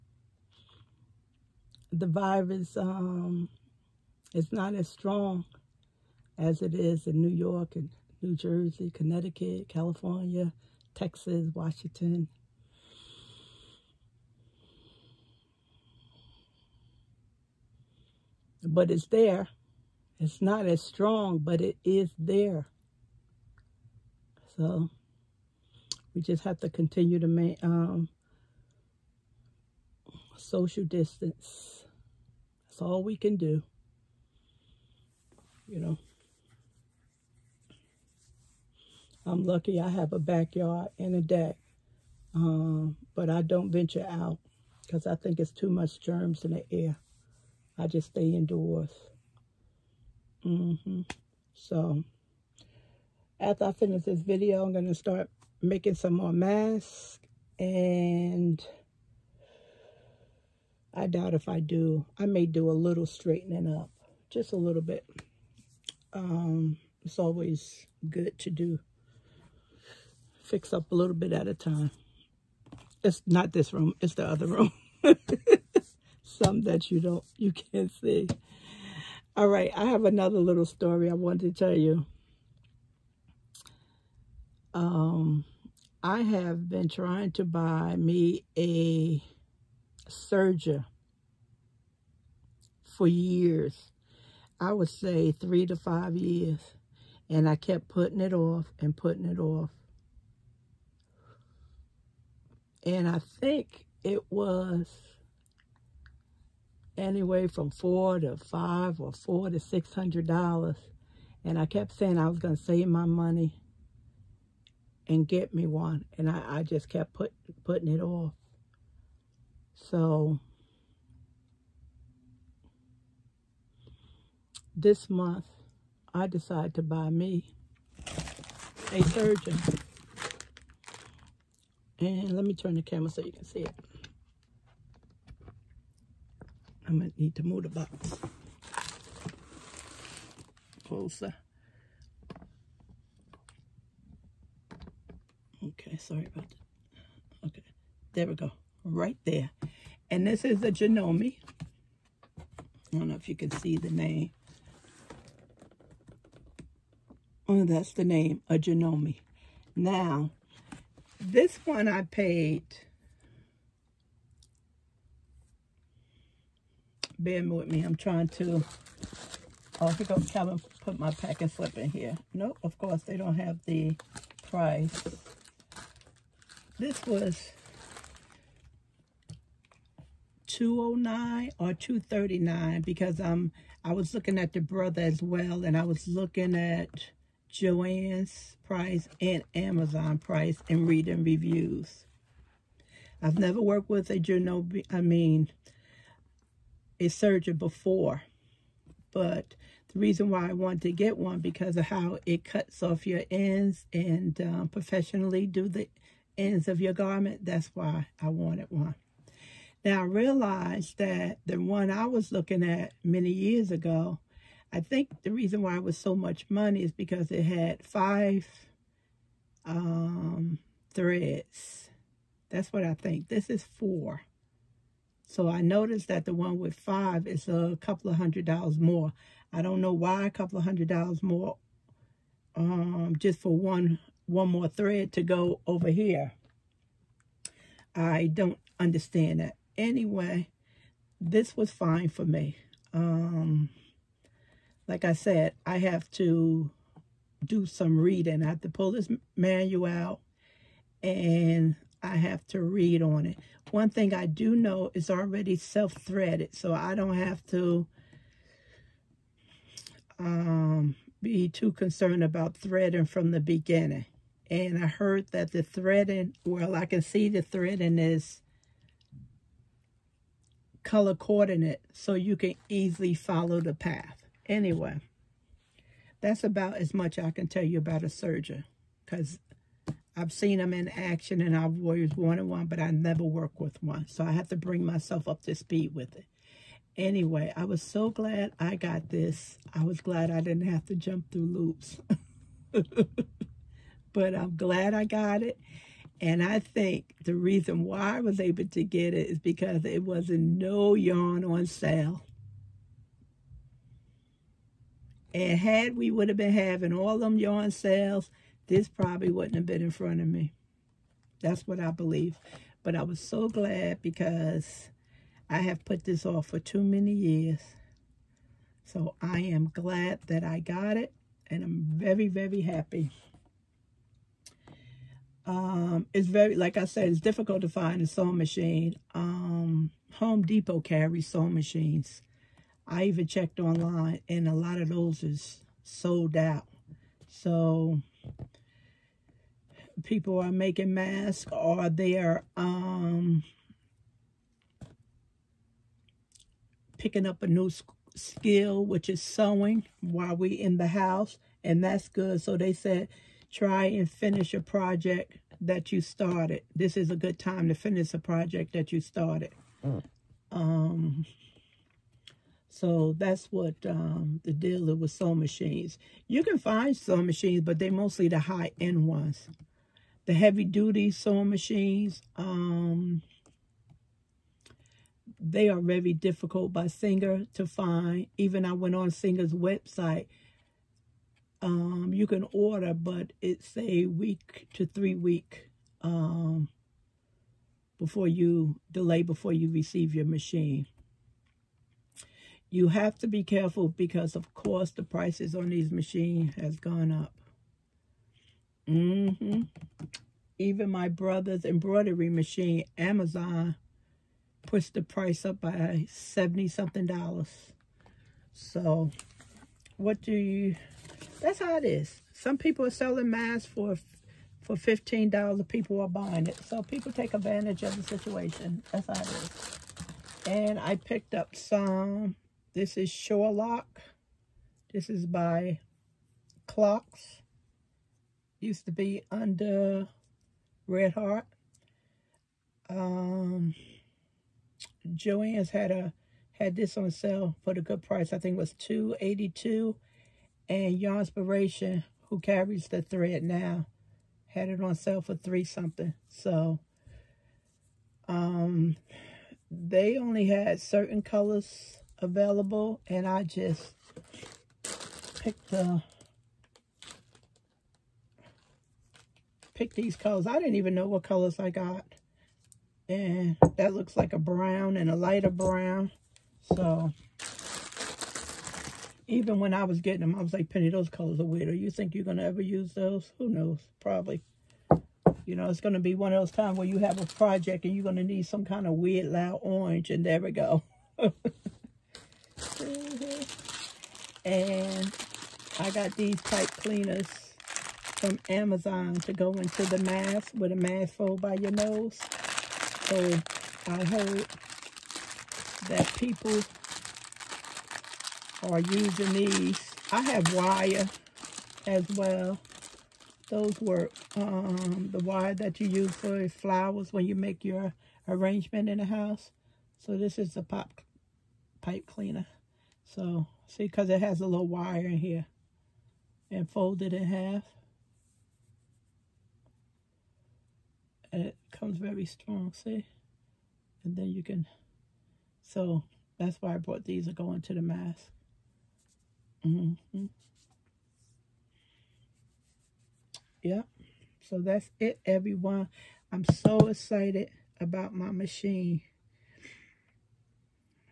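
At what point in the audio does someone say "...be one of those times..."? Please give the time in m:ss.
7:55.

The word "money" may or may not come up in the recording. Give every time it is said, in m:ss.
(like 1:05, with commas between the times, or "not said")
1:53, 3:36.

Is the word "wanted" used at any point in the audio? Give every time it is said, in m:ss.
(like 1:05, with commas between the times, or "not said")
1:21, 3:20, 3:28, 4:42.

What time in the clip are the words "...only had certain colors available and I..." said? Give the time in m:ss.
7:30.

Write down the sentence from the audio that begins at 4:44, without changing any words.
So I have to bring myself up to speed with it.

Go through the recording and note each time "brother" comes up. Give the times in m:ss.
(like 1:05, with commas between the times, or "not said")
3:04, 6:41.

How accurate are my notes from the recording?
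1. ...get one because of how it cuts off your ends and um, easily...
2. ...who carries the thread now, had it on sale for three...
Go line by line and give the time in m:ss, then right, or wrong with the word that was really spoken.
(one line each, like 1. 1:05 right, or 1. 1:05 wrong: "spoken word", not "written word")
1. 3:20 wrong: "professionally", not "easily"
2. 7:22 right.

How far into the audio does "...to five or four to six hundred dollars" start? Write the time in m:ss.
1:48.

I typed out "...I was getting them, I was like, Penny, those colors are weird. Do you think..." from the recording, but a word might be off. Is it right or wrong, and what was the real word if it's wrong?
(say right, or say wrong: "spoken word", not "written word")
right.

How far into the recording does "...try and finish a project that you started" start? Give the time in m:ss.
5:53.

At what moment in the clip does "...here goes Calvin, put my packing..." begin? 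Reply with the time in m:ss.
2:49.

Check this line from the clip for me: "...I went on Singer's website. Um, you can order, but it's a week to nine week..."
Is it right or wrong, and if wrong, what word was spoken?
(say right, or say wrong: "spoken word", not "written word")
wrong: "three", not "nine".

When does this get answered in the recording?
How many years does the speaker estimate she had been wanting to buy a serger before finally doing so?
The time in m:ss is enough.
1:35.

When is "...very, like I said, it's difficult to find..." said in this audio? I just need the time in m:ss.
5:26.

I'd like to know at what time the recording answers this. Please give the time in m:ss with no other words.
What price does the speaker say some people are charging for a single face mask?
6:54.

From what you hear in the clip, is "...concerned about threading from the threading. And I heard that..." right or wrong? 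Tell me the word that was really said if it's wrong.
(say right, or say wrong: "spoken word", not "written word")
wrong: "beginning", not "threading".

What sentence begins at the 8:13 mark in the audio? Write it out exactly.
So I heard that people are using these.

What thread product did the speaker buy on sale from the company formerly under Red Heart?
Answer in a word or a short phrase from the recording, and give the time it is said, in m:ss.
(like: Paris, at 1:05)
Surelock, at 7:03.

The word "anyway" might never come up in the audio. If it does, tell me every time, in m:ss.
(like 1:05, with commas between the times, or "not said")
1:46, 3:59, 4:34, 4:46.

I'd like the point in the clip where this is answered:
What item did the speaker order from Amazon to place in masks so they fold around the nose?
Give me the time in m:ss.
8:06.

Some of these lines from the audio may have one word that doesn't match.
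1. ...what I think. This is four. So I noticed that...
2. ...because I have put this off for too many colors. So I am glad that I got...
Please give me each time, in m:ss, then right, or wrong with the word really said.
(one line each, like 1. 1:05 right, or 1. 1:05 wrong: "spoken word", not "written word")
1. 3:42 right
2. 5:14 wrong: "years", not "colors".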